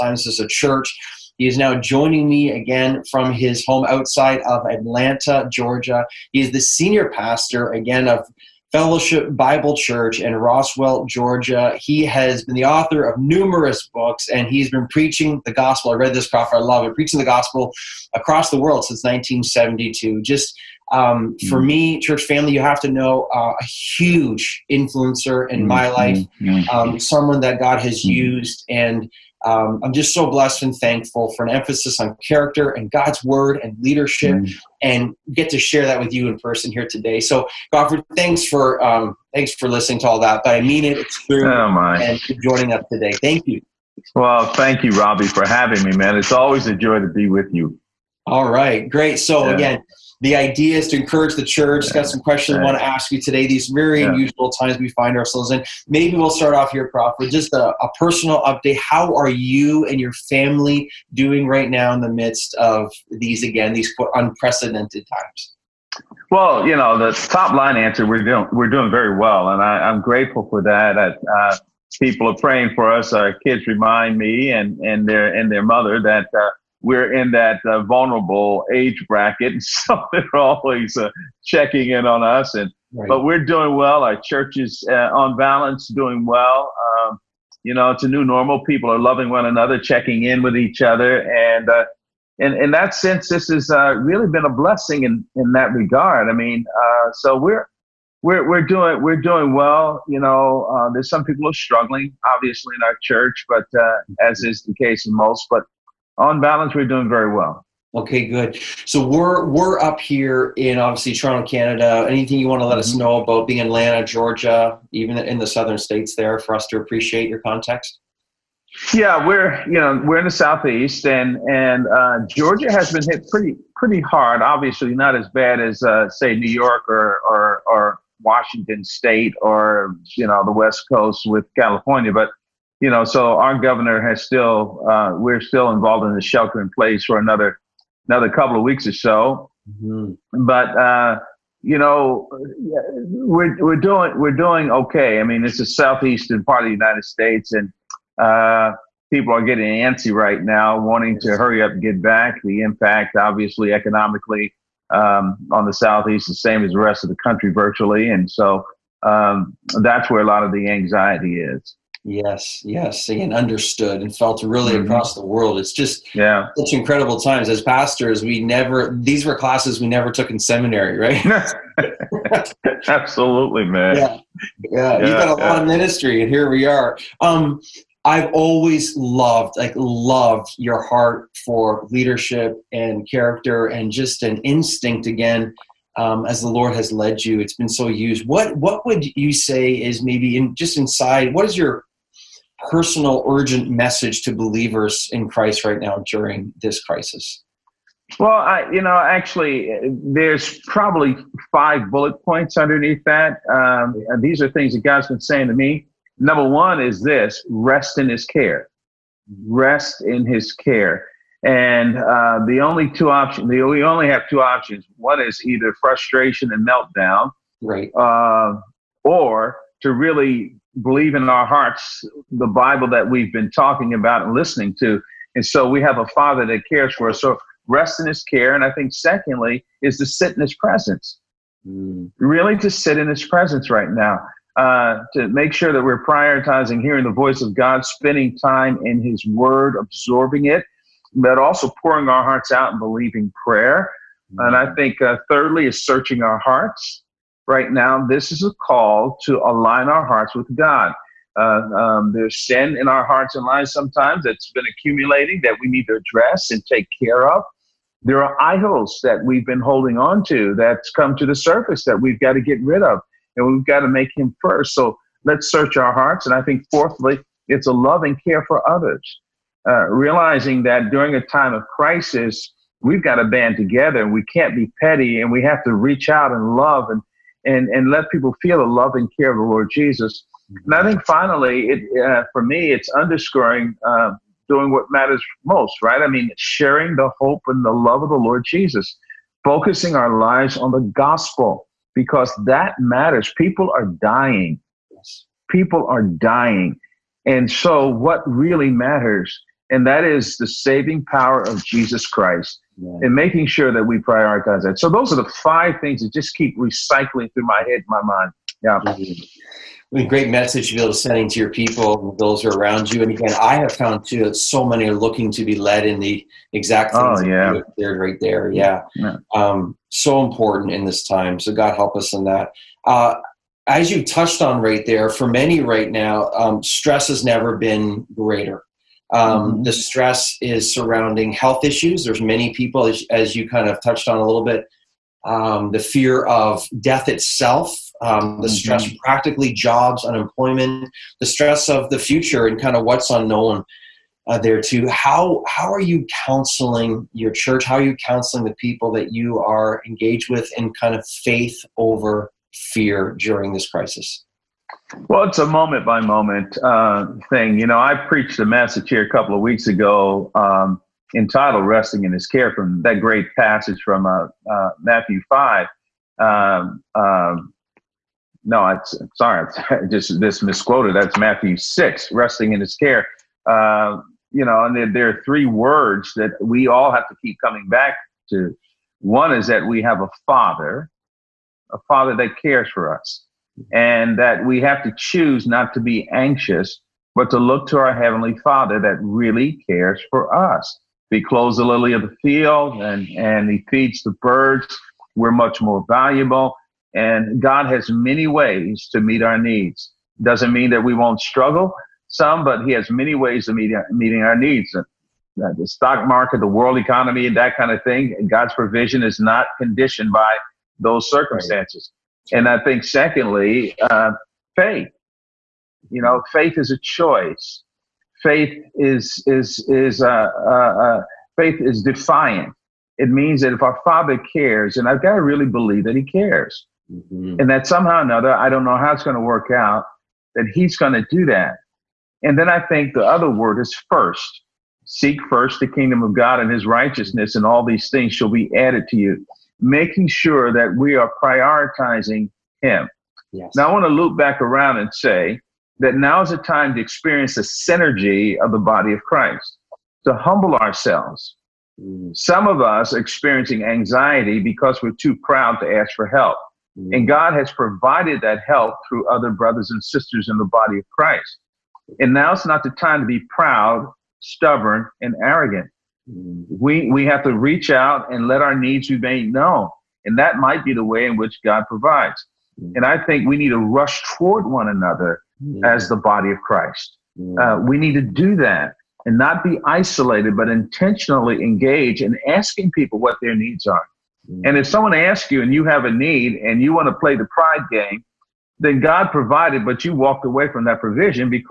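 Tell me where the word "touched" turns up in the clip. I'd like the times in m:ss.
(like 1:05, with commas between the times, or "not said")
5:24, 5:33.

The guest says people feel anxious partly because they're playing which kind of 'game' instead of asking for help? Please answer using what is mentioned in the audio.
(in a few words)
the pride game.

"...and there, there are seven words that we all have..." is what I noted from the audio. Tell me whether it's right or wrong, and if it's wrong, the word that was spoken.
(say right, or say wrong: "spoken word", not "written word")
wrong: "three", not "seven".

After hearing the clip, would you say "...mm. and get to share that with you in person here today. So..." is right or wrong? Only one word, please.
right.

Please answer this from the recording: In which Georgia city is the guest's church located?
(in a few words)
Roswell.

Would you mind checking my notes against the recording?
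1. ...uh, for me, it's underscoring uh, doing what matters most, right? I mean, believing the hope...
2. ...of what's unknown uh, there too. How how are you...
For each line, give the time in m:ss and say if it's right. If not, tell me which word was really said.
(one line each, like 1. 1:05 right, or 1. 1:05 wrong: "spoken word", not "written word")
1. 4:42 wrong: "sharing", not "believing"
2. 5:42 right.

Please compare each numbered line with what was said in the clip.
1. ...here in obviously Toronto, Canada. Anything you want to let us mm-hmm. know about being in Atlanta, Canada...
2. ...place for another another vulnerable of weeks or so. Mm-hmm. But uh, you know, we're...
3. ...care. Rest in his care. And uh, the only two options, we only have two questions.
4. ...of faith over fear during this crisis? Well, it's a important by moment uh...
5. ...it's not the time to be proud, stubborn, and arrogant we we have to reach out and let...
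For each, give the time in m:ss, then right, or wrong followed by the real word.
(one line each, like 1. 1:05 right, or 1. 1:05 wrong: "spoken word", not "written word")
1. 1:50 wrong: "Georgia", not "Canada"
2. 2:16 wrong: "couple", not "vulnerable"
3. 3:28 wrong: "options", not "questions"
4. 5:50 wrong: "moment", not "important"
5. 7:42 right.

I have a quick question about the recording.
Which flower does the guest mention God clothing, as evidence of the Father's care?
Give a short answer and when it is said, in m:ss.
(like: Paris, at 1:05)
lily, at 6:31.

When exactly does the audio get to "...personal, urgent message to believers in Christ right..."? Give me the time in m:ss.
3:12.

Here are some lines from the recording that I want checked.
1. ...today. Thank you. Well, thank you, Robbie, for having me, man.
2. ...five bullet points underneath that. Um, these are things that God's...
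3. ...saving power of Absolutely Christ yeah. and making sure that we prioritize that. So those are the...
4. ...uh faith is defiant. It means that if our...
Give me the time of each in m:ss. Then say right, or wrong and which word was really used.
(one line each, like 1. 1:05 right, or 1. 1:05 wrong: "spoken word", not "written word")
1. 0:42 right
2. 3:21 right
3. 5:00 wrong: "Jesus", not "Absolutely"
4. 7:00 right.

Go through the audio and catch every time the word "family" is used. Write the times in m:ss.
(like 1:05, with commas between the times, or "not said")
0:22, 1:00.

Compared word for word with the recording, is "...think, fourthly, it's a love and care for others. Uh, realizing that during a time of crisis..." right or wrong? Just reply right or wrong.
right.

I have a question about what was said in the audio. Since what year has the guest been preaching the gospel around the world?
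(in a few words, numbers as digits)
1972.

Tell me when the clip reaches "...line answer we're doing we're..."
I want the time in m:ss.
1:07.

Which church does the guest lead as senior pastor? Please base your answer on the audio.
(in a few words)
Fellowship Bible Church.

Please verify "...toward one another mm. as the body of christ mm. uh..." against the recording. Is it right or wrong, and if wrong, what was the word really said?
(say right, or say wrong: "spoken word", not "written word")
right.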